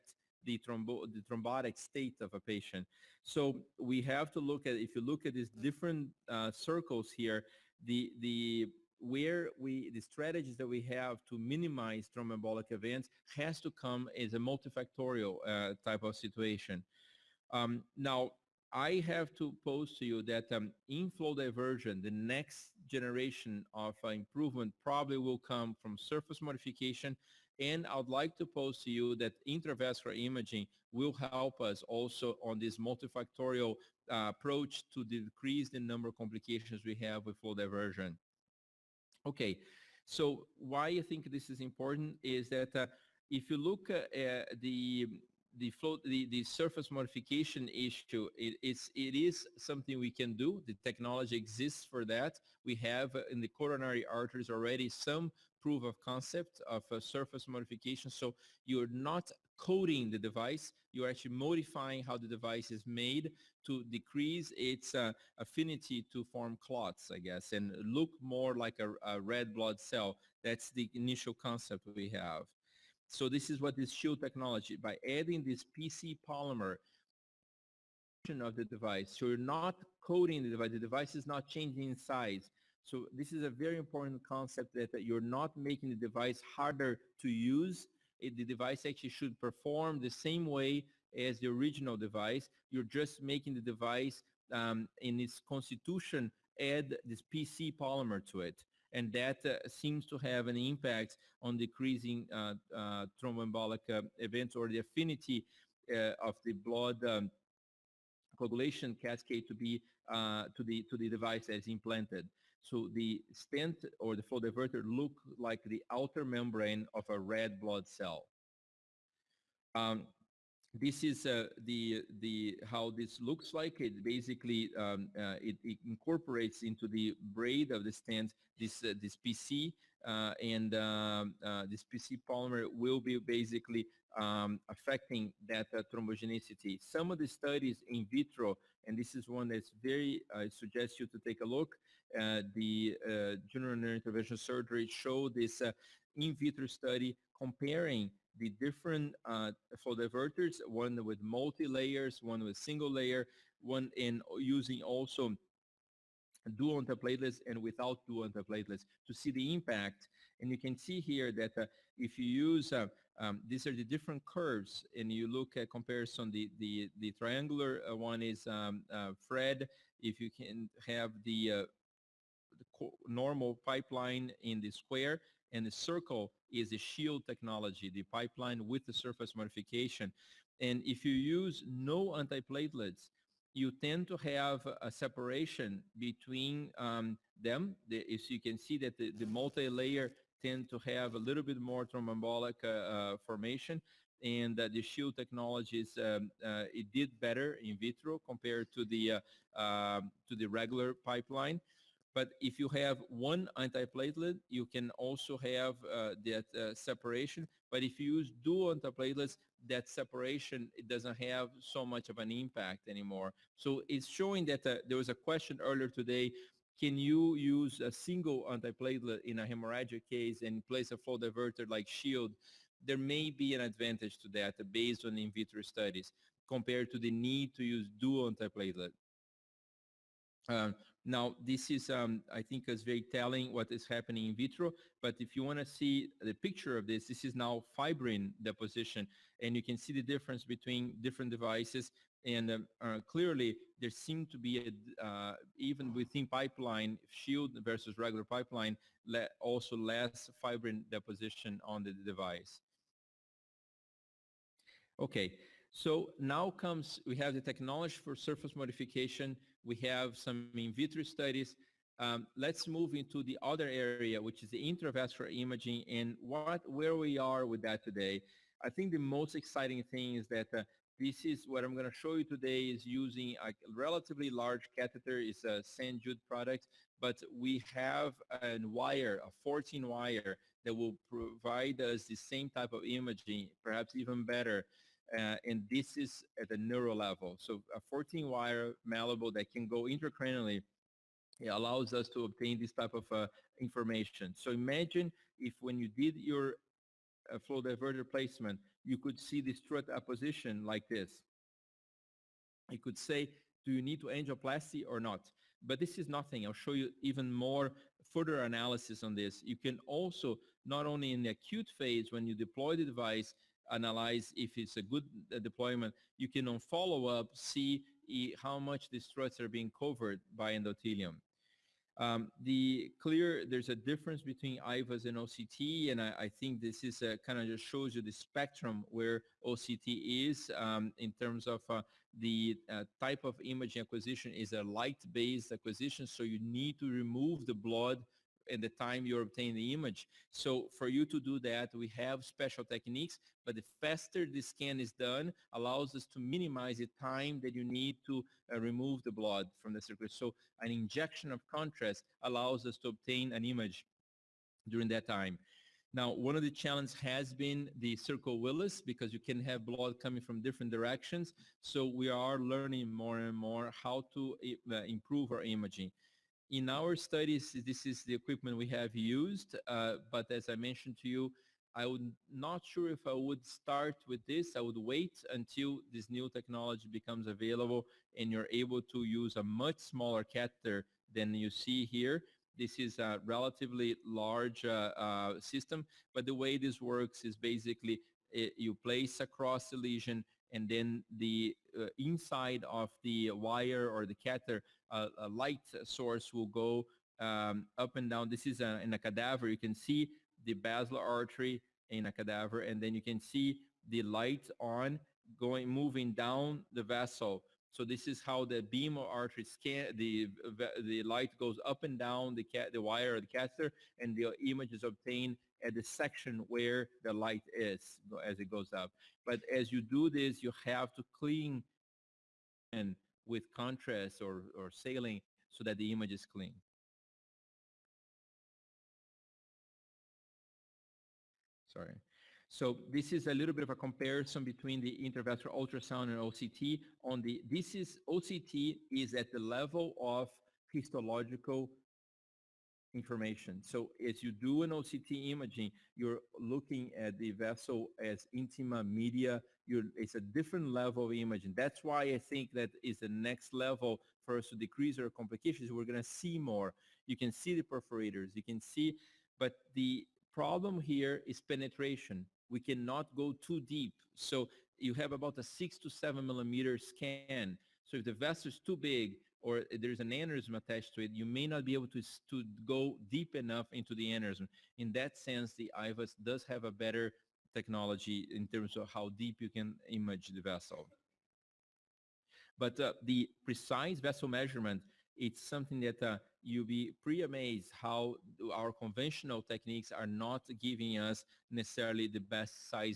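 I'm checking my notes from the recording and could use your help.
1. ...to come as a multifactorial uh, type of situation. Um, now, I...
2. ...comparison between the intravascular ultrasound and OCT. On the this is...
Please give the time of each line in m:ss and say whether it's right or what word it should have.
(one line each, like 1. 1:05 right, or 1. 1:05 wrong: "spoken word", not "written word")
1. 0:13 right
2. 7:13 right.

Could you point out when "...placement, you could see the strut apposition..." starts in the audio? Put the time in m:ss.
4:58.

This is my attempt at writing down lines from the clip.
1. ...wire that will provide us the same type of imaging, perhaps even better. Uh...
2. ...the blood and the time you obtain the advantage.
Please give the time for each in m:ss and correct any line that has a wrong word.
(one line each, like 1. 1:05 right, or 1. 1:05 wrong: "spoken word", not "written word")
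1. 4:39 right
2. 5:37 wrong: "image", not "advantage".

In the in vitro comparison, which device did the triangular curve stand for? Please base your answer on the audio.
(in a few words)
Fred.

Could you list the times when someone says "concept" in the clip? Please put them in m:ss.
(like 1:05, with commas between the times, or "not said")
0:56, 1:11, 1:24.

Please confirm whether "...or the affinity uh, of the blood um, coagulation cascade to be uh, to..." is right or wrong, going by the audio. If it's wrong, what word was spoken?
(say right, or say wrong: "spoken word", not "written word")
right.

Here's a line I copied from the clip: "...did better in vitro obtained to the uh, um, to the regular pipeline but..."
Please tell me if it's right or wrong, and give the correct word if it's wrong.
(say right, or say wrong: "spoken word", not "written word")
wrong: "compared", not "obtained".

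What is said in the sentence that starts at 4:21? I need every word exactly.
Um, let's move into the other area, which is the intravascular imaging and what, where we are with that today.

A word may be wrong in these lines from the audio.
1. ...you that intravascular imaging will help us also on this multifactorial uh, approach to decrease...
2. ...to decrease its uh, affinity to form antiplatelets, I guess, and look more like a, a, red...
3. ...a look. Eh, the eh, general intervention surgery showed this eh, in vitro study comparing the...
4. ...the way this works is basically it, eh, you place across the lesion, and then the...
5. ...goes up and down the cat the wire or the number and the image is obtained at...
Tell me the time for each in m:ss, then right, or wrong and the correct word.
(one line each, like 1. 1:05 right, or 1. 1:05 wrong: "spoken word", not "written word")
1. 0:28 right
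2. 1:03 wrong: "clots", not "antiplatelets"
3. 2:21 right
4. 6:26 right
5. 6:51 wrong: "catheter", not "number".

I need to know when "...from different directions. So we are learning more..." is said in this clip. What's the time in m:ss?
6:00.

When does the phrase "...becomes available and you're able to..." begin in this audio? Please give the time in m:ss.
6:16.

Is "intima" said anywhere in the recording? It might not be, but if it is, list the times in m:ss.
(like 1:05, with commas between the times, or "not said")
7:28.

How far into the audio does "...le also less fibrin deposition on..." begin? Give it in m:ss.
4:09.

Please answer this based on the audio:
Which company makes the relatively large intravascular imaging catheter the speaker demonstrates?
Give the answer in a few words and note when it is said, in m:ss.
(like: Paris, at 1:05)
St. Jude, at 4:35.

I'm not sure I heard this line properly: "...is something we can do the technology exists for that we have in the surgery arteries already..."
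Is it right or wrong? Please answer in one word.
wrong.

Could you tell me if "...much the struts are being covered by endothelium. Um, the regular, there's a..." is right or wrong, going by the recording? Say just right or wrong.
wrong.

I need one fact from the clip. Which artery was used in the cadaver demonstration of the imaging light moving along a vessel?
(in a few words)
Basilar artery.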